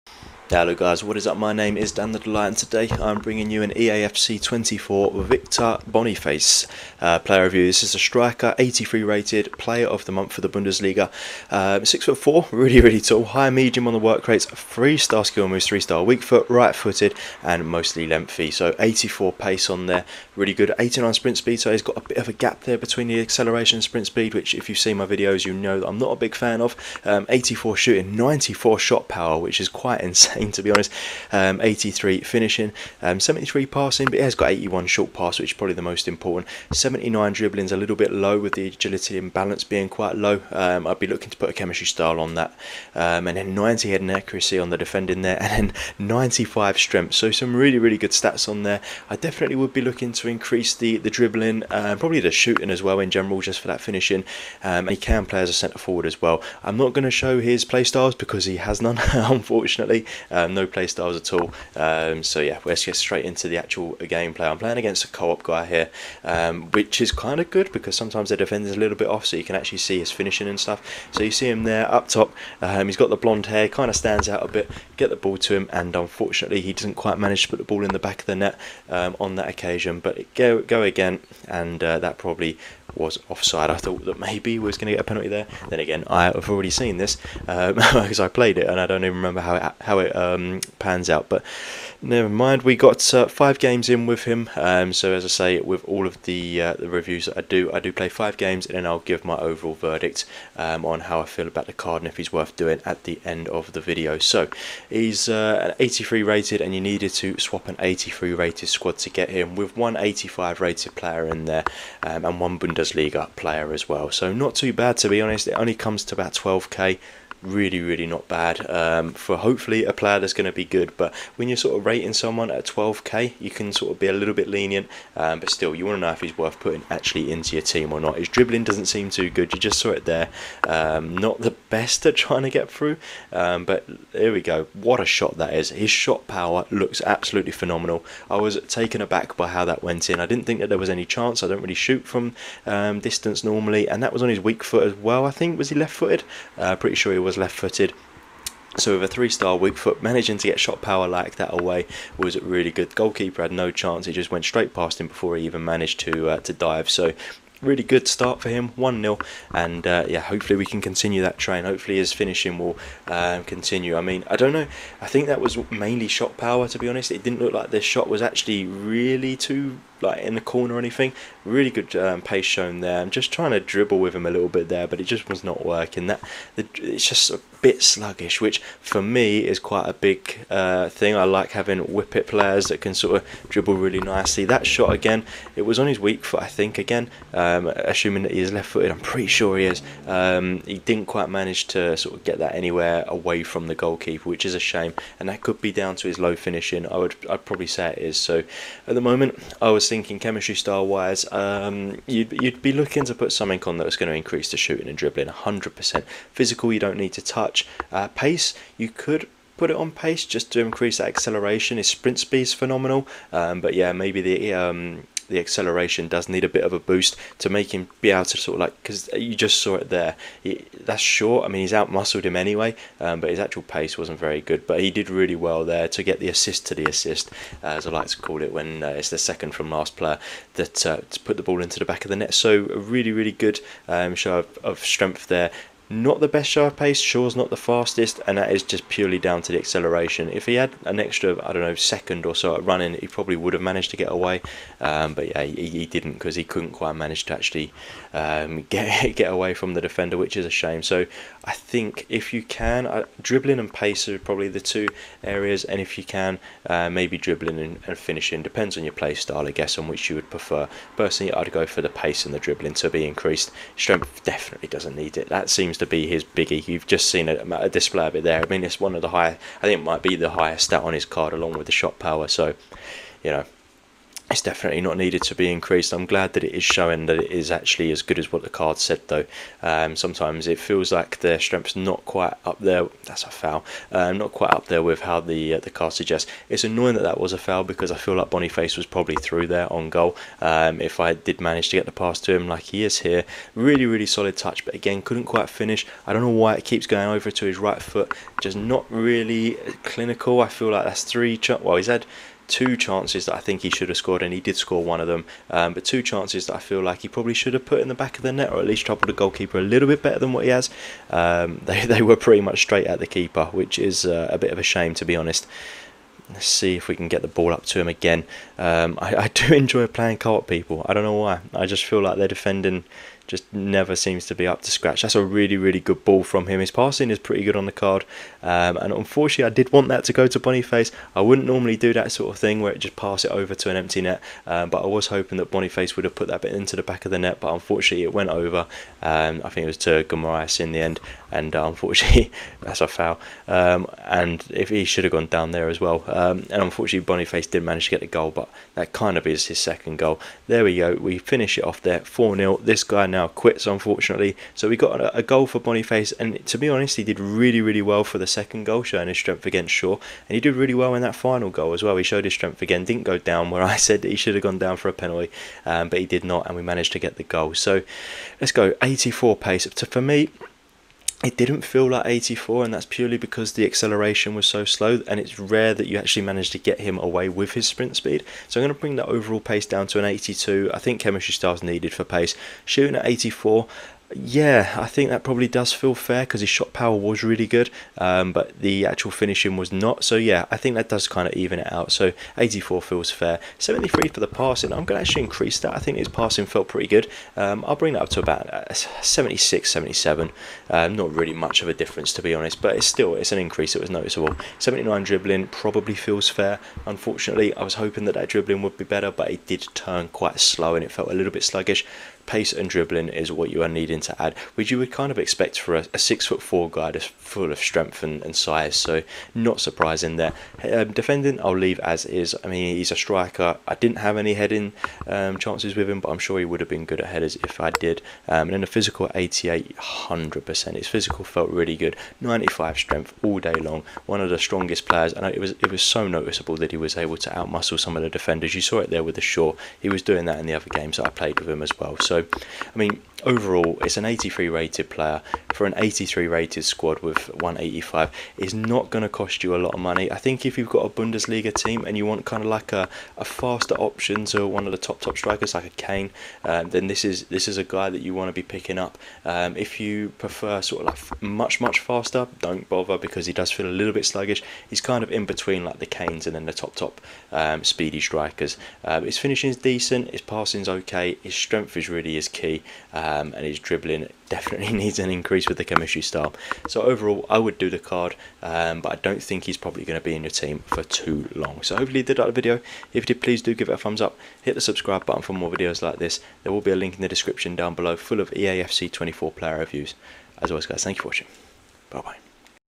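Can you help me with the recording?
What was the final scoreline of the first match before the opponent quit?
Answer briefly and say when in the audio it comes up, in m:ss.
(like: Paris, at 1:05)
4-0, at 5:52.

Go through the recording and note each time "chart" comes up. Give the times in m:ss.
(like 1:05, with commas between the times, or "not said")
not said.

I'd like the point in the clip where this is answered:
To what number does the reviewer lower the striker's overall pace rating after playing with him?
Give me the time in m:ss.
6:20.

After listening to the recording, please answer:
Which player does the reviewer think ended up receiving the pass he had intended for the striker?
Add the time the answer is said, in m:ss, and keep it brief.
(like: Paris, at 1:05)
Guimarães, at 5:40.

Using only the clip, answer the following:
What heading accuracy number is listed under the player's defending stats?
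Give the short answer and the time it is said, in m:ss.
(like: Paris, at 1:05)
90, at 0:43.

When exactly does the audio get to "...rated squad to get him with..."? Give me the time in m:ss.
1:48.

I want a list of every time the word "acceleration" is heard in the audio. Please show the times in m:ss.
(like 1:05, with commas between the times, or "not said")
0:23, 3:31, 3:35, 3:59, 6:13.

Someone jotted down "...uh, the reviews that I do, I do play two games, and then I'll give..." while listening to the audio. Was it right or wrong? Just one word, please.
wrong.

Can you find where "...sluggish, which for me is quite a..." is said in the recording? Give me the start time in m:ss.
2:57.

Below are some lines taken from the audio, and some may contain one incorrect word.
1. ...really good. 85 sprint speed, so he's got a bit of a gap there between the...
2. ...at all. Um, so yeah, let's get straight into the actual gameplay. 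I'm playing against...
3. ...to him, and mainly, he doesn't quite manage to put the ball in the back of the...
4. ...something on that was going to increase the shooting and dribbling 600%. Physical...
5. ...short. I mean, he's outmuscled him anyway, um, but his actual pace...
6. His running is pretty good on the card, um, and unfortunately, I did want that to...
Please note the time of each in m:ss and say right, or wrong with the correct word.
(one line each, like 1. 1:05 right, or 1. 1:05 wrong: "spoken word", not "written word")
1. 0:20 wrong: "89", not "85"
2. 1:01 right
3. 1:15 wrong: "unfortunately", not "mainly"
4. 3:23 wrong: "100", not "600"
5. 3:41 right
6. 5:26 wrong: "passing", not "running".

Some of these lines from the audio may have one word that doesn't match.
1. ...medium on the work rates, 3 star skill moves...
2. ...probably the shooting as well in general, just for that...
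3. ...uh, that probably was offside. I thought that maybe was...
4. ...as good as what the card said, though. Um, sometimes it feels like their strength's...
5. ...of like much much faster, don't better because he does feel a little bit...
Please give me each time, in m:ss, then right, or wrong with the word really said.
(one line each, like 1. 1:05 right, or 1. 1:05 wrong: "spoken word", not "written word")
1. 0:13 right
2. 0:51 right
3. 1:21 right
4. 4:37 right
5. 7:40 wrong: "bother", not "better".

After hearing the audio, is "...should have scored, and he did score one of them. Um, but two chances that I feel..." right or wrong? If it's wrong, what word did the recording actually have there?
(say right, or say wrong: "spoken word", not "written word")
right.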